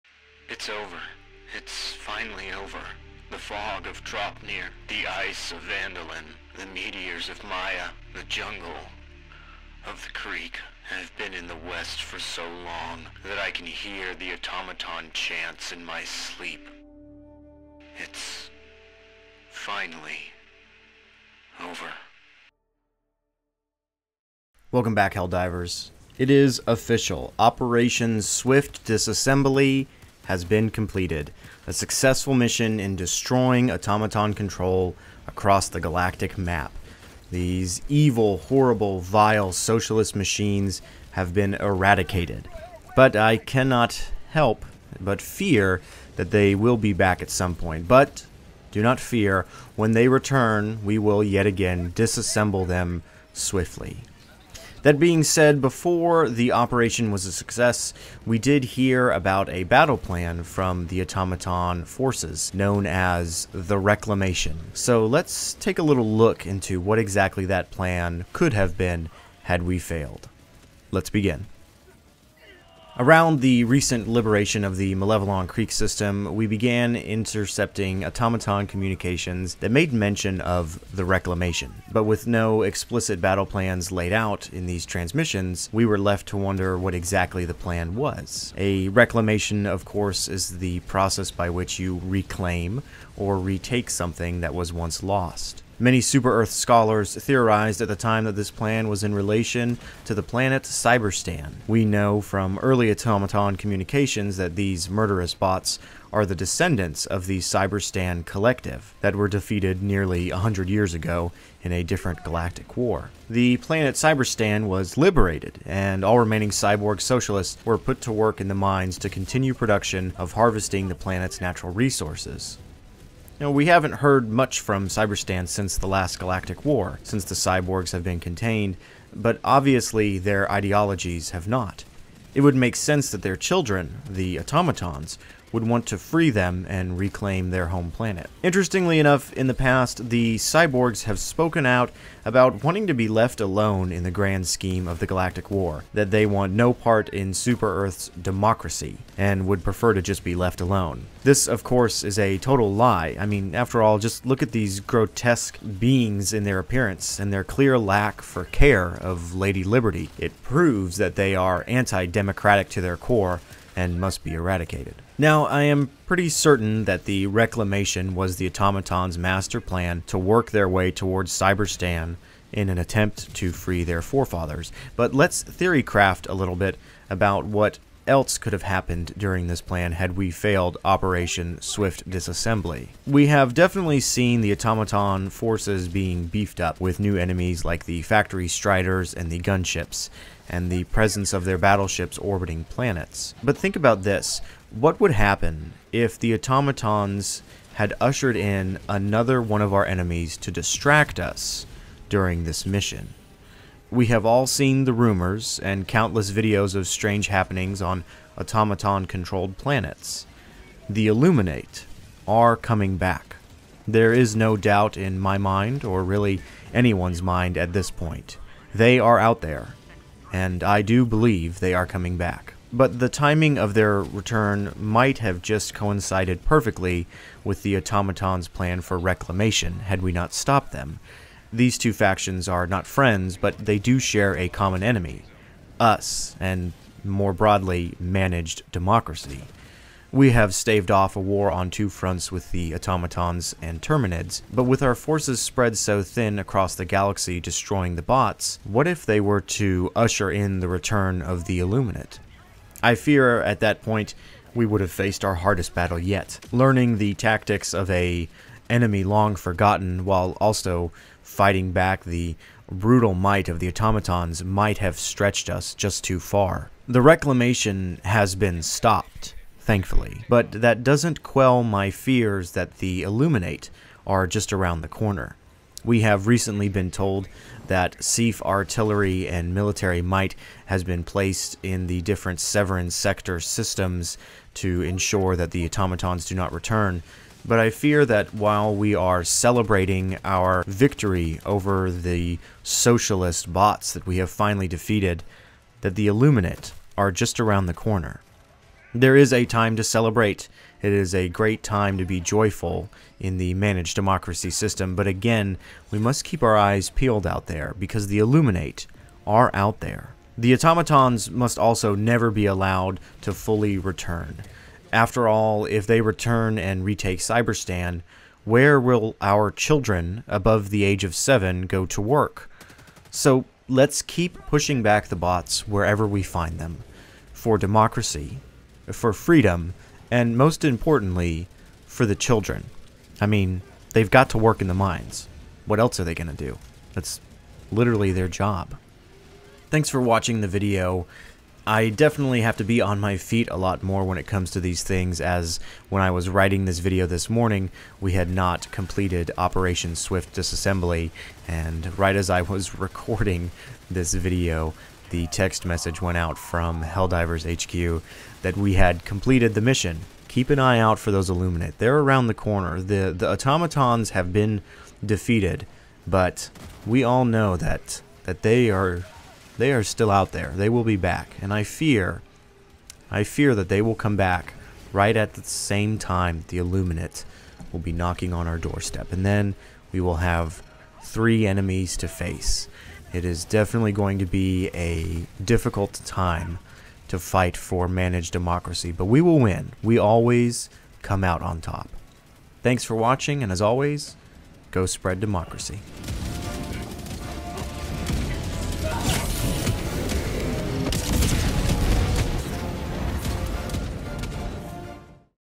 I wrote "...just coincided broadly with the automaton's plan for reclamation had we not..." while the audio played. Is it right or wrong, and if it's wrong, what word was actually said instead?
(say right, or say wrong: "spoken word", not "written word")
wrong: "perfectly", not "broadly".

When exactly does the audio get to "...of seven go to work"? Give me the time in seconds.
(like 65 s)
321 s.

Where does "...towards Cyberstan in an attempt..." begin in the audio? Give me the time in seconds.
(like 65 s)
170 s.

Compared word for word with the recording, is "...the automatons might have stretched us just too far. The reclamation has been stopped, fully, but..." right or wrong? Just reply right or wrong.
wrong.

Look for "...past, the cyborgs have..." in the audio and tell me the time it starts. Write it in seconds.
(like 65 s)
139 s.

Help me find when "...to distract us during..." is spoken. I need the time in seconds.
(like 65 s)
200 s.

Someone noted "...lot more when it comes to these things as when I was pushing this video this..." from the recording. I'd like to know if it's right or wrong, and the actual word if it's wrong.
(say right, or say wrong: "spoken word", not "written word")
wrong: "writing", not "pushing".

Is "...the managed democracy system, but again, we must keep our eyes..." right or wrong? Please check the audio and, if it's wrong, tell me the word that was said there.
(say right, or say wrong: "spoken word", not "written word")
right.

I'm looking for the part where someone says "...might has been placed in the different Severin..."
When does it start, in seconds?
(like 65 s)
280 s.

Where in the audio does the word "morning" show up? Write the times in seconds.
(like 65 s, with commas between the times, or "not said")
347 s.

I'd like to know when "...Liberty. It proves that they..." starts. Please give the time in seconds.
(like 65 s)
159 s.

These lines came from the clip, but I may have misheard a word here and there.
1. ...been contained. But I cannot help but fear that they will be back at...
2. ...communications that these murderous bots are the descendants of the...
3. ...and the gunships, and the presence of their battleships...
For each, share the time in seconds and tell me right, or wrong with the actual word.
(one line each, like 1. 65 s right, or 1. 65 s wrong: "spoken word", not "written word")
1. 41 s wrong: "eradicated", not "contained"
2. 103 s right
3. 189 s right.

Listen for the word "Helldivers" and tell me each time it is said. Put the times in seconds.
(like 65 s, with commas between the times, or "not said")
25 s, 356 s.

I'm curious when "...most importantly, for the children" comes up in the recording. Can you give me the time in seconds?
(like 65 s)
330 s.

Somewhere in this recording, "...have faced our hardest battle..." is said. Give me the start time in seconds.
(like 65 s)
254 s.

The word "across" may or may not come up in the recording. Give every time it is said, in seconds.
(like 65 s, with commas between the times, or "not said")
35 s, 246 s.